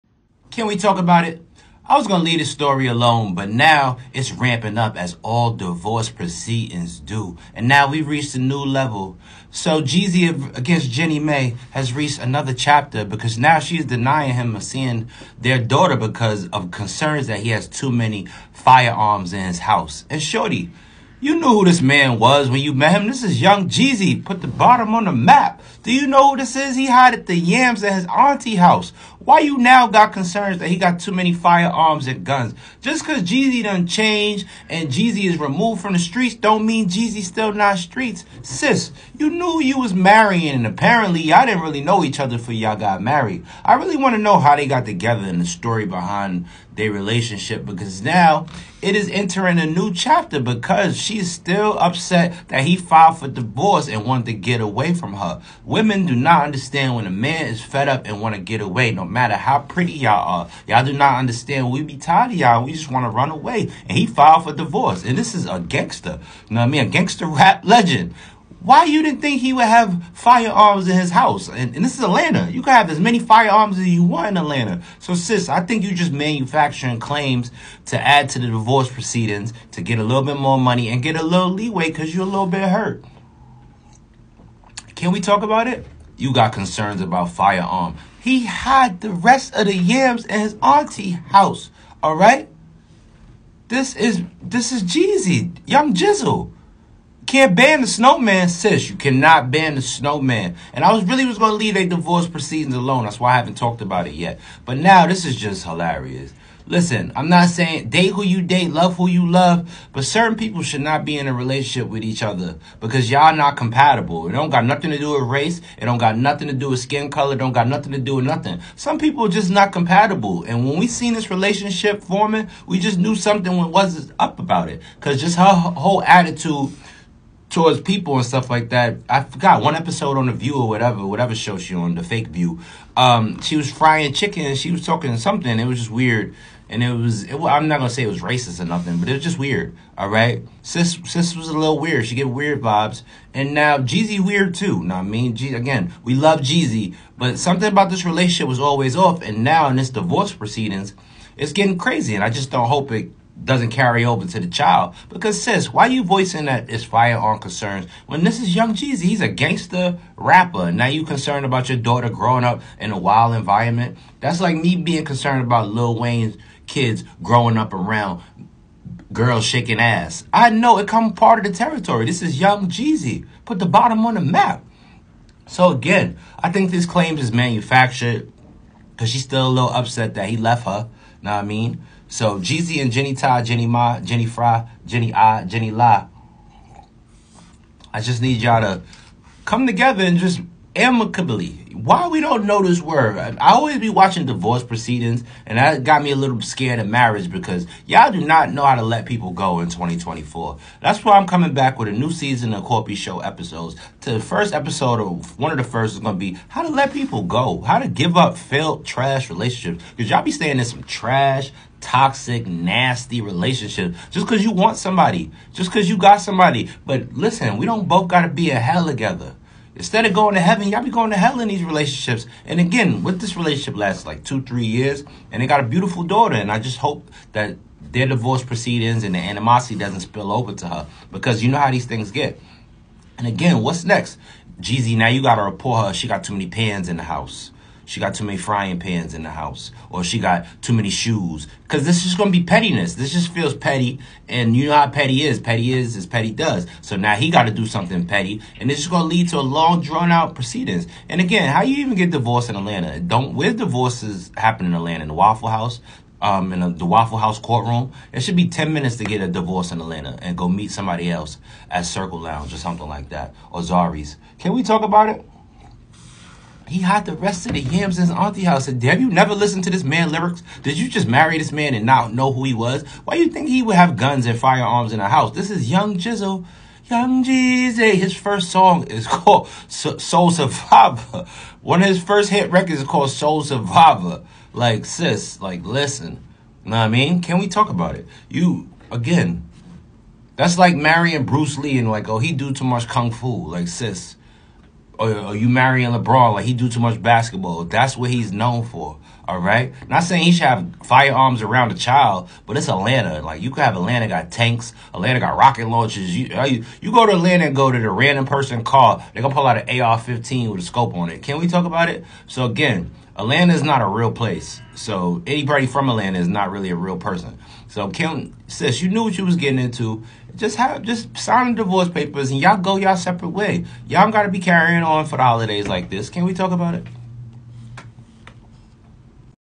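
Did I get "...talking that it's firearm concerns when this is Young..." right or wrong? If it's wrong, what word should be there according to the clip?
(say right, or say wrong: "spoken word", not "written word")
wrong: "voicing", not "talking".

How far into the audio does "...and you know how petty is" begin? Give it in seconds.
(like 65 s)
244 s.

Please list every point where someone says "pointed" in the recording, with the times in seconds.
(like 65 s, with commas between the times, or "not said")
not said.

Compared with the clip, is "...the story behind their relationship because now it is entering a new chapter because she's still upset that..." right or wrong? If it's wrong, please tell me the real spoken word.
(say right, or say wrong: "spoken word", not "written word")
right.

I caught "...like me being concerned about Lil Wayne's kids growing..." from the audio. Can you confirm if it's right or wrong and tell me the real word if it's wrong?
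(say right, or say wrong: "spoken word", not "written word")
right.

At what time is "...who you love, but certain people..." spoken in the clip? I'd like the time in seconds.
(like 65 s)
108 s.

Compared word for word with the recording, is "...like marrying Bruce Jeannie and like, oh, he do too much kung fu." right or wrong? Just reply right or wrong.
wrong.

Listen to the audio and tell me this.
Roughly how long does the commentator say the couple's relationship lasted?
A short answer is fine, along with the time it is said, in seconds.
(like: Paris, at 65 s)
Two, three years, at 224 s.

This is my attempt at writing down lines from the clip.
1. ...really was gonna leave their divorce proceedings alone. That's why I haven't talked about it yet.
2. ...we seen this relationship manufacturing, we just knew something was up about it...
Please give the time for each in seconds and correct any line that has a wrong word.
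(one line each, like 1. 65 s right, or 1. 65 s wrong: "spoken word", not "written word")
1. 101 s right
2. 120 s wrong: "forming", not "manufacturing".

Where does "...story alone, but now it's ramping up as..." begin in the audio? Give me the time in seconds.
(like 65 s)
2 s.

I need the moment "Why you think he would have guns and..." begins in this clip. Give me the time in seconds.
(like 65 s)
273 s.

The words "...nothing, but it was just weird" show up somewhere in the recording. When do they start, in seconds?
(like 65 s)
138 s.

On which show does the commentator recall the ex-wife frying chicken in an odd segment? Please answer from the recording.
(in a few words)
The View.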